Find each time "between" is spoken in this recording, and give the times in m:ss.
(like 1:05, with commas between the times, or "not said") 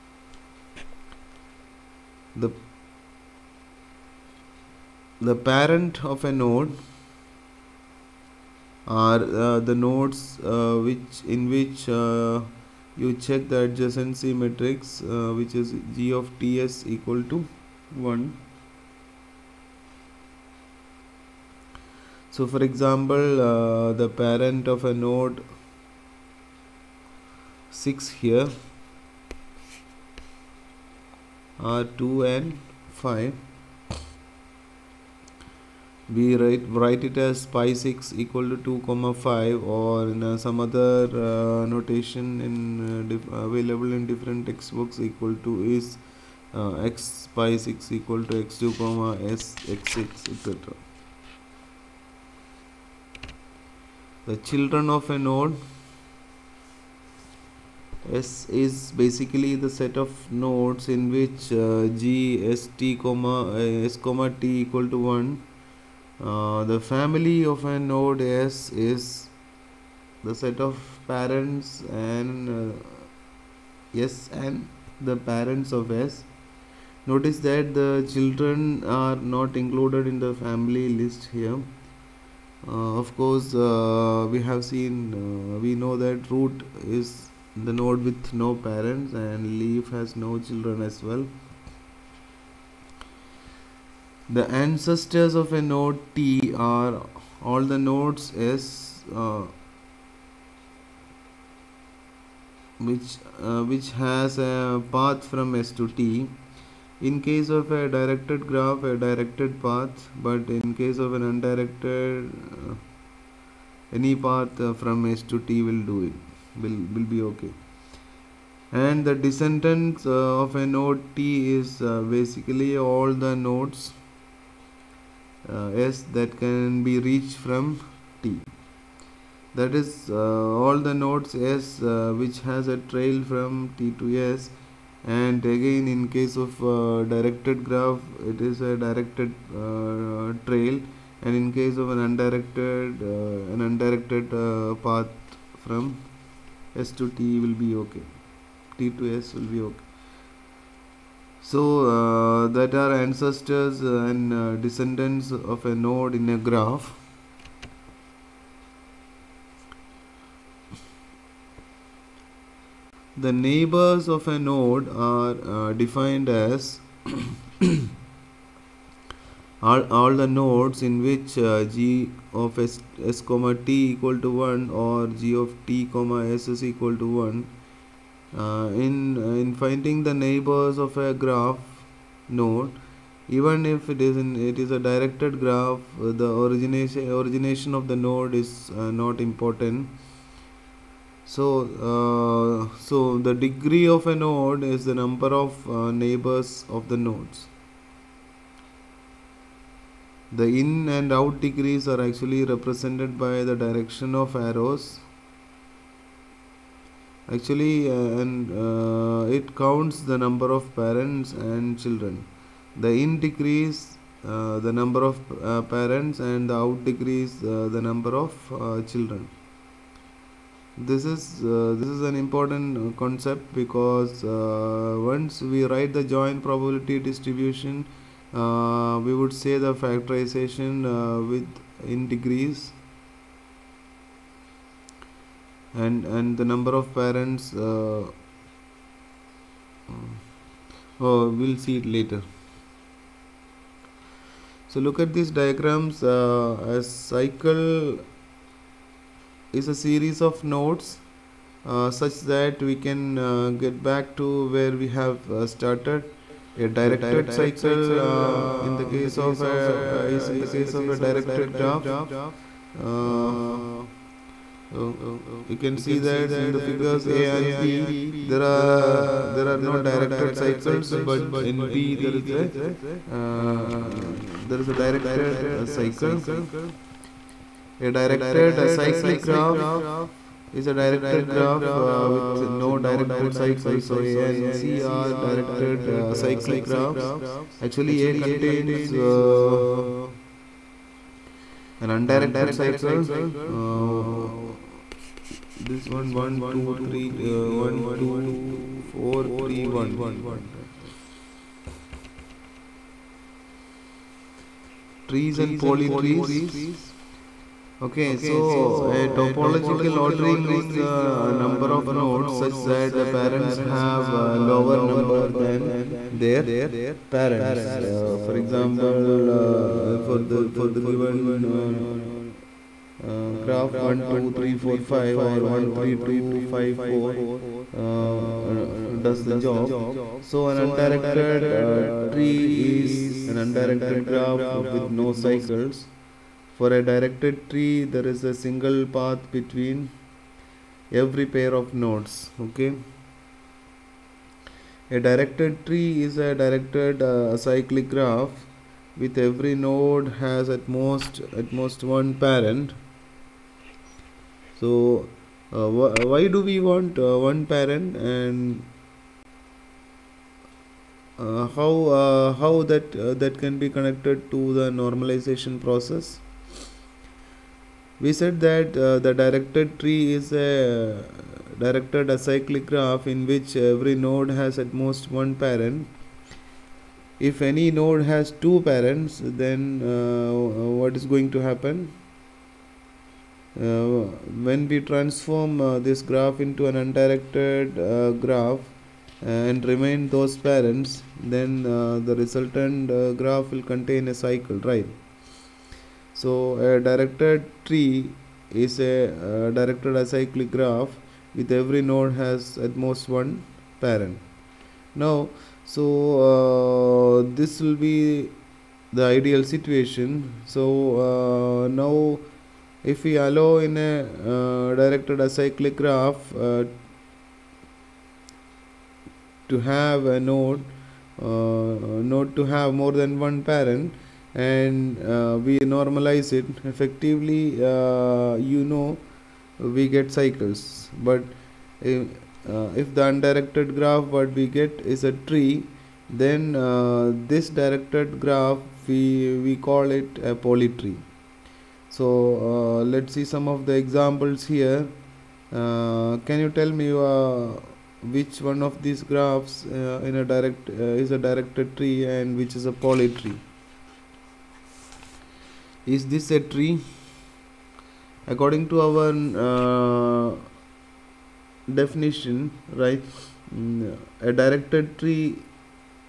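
5:39.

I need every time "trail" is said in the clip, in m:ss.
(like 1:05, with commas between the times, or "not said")
2:12, 2:20.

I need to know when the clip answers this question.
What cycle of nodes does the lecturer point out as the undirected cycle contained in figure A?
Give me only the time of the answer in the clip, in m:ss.
4:56.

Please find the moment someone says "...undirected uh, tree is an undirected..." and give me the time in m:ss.
5:30.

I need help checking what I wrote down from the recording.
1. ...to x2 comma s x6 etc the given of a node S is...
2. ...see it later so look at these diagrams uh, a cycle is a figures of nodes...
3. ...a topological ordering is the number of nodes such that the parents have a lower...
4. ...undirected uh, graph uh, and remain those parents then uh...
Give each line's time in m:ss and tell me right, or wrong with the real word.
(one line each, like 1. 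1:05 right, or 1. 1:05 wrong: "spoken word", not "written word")
1. 0:48 wrong: "children", not "given"
2. 4:01 wrong: "series", not "figures"
3. 5:08 right
4. 6:26 right.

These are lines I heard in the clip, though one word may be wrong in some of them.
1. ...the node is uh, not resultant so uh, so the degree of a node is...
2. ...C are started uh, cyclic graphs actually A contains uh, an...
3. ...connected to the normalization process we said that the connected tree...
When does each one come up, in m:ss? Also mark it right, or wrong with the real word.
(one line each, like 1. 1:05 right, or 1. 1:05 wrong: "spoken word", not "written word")
1. 3:07 wrong: "important", not "resultant"
2. 4:44 wrong: "directed", not "started"
3. 6:03 wrong: "directed", not "connected".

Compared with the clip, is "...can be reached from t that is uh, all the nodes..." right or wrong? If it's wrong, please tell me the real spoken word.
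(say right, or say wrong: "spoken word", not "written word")
right.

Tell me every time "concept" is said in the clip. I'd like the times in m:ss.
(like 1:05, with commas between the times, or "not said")
3:42.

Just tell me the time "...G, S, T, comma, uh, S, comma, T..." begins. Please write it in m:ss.
1:01.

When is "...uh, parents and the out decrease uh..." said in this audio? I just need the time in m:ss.
3:35.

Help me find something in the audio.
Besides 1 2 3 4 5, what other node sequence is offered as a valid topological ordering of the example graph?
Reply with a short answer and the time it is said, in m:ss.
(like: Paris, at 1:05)
1 3 2 5 4, at 5:25.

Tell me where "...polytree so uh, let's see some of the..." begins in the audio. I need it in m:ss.
7:20.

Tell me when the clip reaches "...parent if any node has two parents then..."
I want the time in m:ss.
6:15.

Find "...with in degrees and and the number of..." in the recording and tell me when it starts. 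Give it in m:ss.
3:51.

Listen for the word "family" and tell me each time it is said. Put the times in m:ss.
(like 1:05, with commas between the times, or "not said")
1:06, 1:20.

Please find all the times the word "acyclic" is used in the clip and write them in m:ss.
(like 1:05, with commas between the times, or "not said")
4:38, 6:12, 6:39, 6:55.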